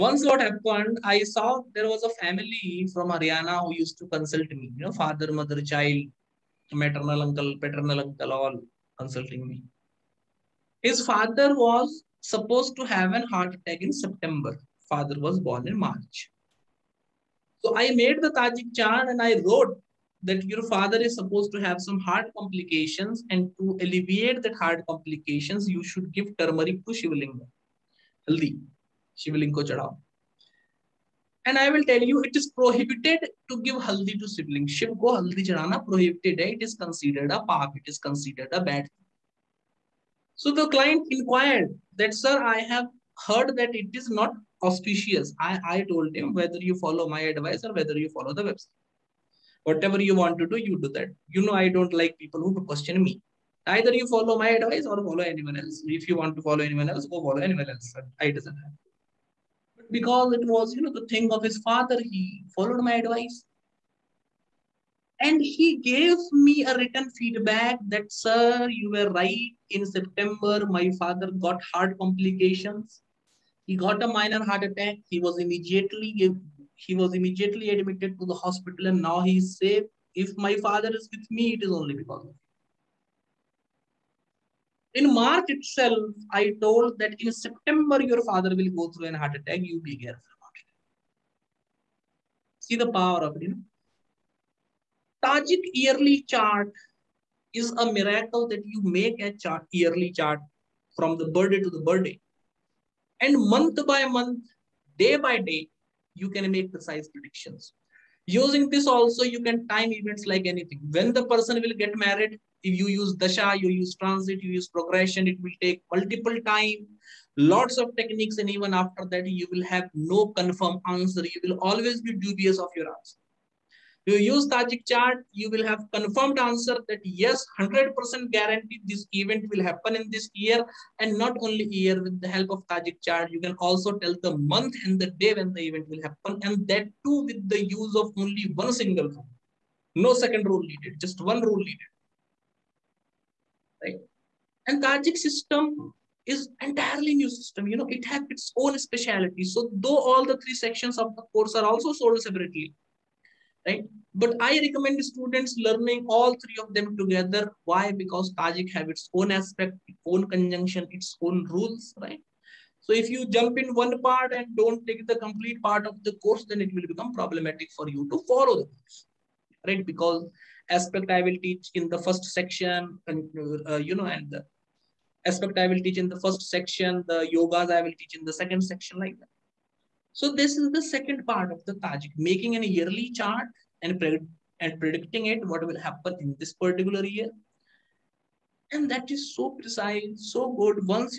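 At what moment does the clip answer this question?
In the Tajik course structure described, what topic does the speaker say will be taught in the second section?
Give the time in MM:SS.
02:57.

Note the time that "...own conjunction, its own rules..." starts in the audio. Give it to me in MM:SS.
02:40.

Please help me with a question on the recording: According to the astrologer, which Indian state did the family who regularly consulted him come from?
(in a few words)
Haryana.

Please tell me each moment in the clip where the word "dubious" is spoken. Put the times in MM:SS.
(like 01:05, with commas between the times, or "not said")
02:02.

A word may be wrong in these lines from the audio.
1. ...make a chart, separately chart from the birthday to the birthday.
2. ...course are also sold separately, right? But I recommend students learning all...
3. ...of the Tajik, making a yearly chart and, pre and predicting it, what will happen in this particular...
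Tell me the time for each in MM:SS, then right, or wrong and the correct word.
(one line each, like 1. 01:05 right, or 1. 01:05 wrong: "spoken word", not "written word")
1. 01:38 wrong: "yearly", not "separately"
2. 02:31 right
3. 03:01 right.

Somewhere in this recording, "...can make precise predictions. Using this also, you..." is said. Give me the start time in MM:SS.
01:46.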